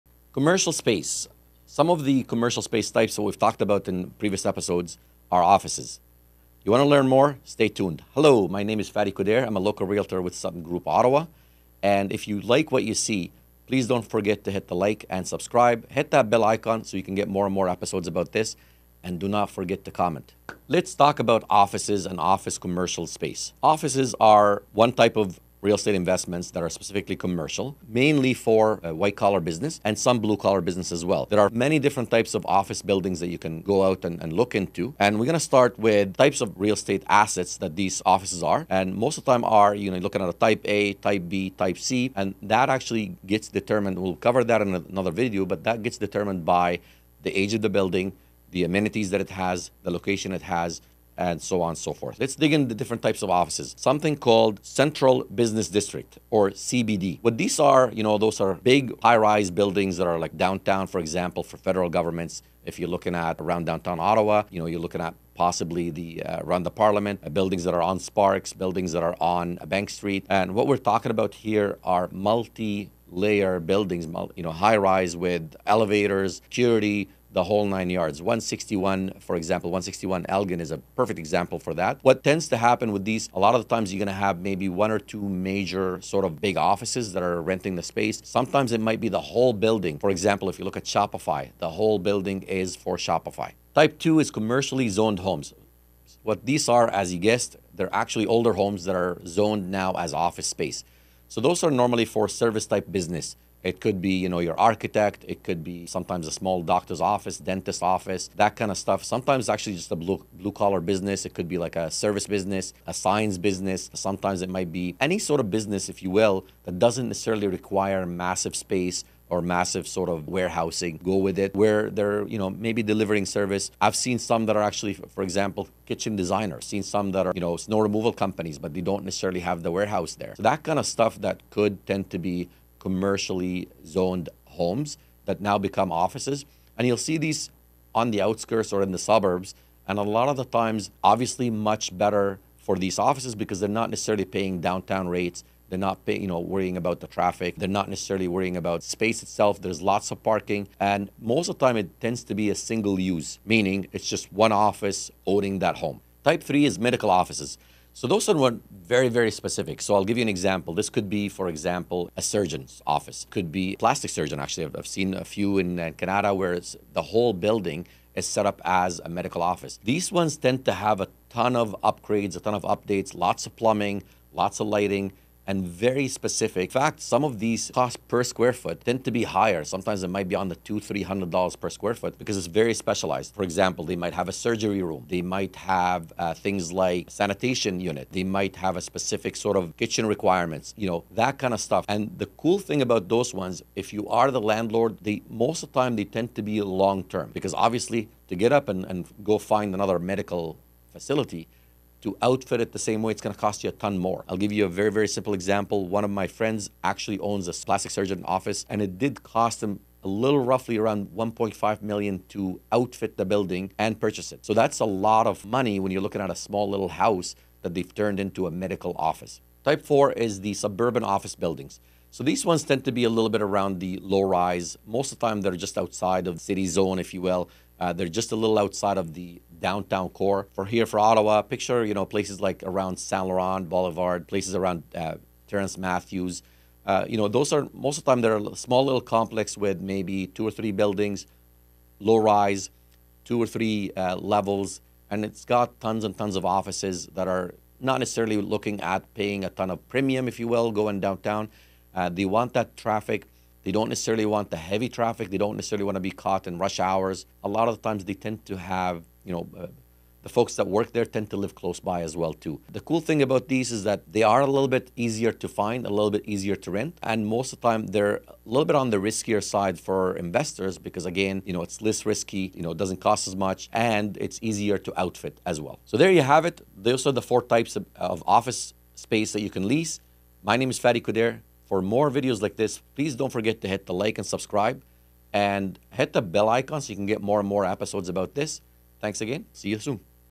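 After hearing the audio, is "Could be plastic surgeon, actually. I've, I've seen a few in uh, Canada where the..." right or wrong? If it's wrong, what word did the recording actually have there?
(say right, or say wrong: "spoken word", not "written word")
right.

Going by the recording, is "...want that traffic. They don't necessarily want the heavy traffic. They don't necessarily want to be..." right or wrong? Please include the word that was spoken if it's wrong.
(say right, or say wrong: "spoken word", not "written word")
right.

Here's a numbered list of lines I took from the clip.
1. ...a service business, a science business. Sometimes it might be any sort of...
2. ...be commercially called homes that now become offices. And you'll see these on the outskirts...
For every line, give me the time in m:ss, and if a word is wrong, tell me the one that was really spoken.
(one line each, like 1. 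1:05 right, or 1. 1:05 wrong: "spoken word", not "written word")
1. 1:51 right
2. 2:12 wrong: "zoned", not "called".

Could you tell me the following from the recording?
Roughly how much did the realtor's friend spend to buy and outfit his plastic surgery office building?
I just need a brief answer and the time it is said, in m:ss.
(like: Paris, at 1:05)
1.5 million, at 3:31.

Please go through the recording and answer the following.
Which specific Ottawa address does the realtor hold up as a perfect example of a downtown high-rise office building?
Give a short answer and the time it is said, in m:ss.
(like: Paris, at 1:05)
161 Elgin, at 1:19.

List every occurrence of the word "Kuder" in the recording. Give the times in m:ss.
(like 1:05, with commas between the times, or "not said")
0:09, 4:41.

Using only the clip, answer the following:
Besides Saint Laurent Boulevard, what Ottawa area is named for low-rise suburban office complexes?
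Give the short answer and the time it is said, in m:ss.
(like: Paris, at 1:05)
Terence Matthews, at 3:55.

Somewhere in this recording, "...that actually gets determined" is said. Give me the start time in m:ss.
0:42.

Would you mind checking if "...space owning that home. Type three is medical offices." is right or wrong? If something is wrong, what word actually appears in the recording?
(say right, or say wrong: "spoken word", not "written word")
wrong: "office", not "space".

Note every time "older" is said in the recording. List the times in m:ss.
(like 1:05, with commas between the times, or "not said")
1:38.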